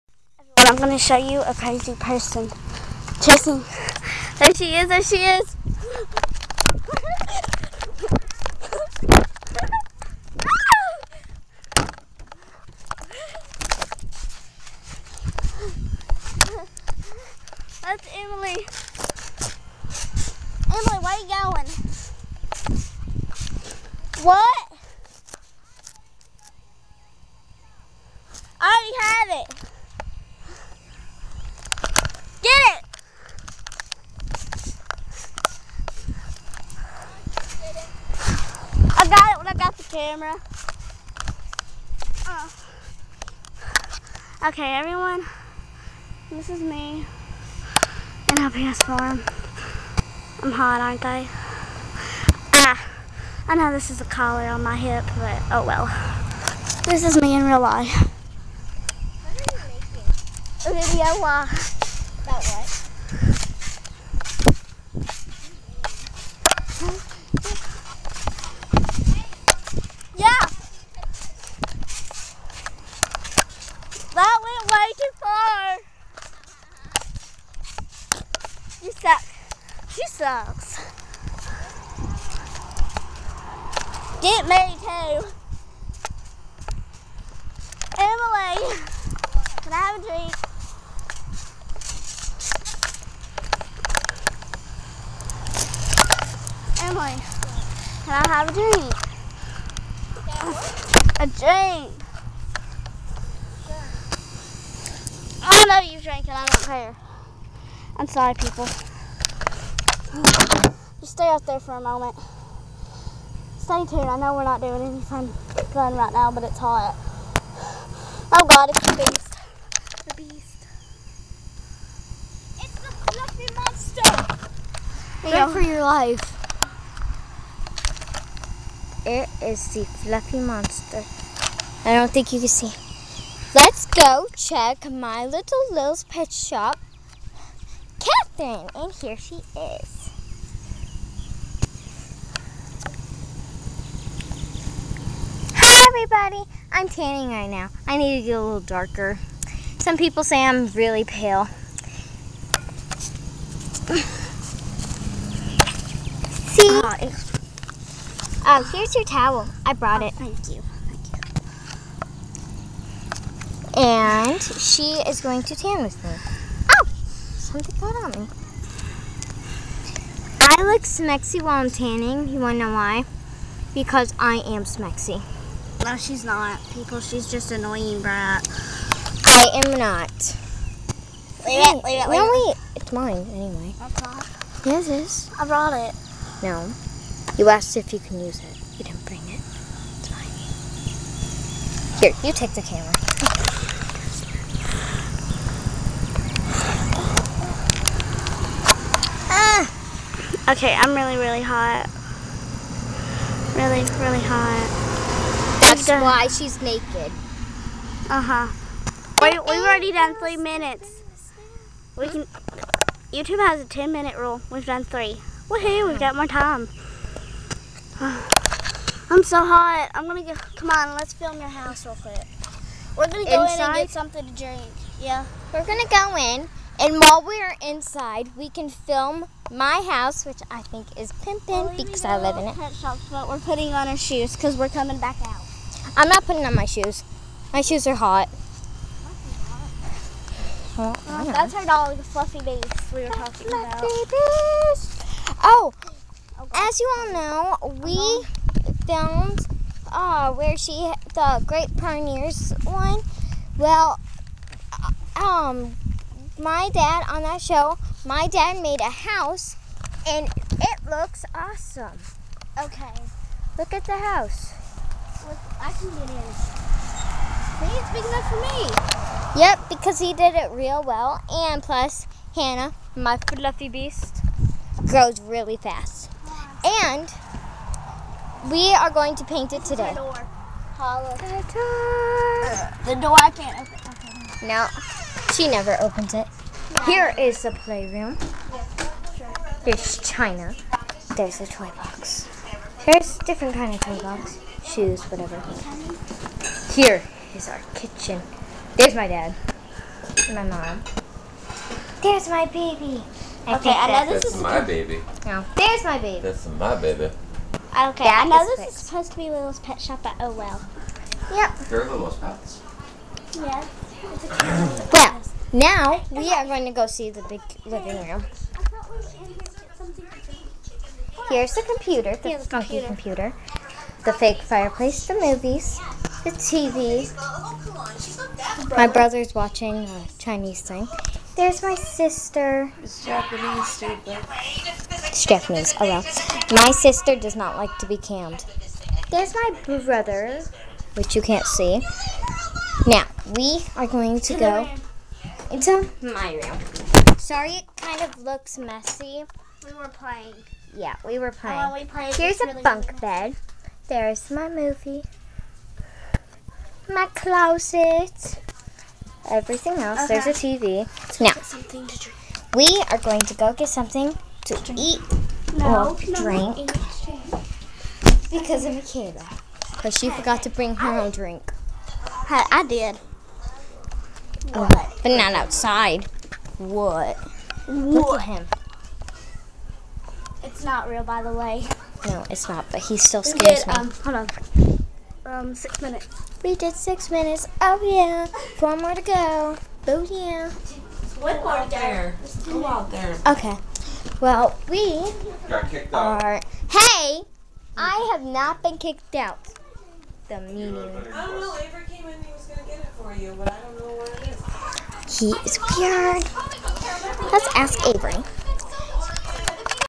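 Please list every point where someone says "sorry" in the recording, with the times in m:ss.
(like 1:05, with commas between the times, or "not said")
1:48, 5:47.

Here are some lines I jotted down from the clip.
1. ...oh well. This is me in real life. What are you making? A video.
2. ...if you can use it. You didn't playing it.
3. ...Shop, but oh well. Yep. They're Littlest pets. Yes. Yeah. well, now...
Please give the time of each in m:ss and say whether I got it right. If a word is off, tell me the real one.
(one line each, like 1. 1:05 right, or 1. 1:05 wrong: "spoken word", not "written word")
1. 0:55 right
2. 3:07 wrong: "bring", not "playing"
3. 5:09 right.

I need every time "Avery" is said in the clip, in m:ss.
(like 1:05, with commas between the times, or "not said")
6:41, 6:47.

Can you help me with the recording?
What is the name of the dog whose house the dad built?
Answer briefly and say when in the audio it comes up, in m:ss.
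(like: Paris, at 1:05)
Hannah, at 4:32.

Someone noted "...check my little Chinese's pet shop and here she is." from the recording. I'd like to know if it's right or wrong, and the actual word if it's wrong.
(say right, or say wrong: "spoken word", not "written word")
wrong: "Lil", not "Chinese".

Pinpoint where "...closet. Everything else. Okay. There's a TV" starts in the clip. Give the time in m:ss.
5:57.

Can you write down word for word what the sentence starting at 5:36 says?
My sister does not like to be cammed.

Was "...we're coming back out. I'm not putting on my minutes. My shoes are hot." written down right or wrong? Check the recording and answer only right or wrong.
wrong.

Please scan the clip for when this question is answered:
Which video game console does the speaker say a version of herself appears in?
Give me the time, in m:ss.
0:48.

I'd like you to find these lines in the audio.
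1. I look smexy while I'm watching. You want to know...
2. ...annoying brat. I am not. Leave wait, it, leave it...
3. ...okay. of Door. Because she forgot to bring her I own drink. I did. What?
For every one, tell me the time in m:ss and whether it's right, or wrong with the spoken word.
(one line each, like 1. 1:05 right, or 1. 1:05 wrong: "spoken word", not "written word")
1. 2:50 wrong: "tanning", not "watching"
2. 2:57 right
3. 6:08 wrong: "Michaela", not "Door".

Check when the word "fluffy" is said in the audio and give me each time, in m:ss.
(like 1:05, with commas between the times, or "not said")
2:03, 2:09, 4:02, 4:33.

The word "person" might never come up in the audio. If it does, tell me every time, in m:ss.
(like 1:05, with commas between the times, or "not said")
0:01.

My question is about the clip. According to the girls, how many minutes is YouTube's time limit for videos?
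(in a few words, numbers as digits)
10.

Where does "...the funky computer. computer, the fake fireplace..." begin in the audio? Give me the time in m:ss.
5:22.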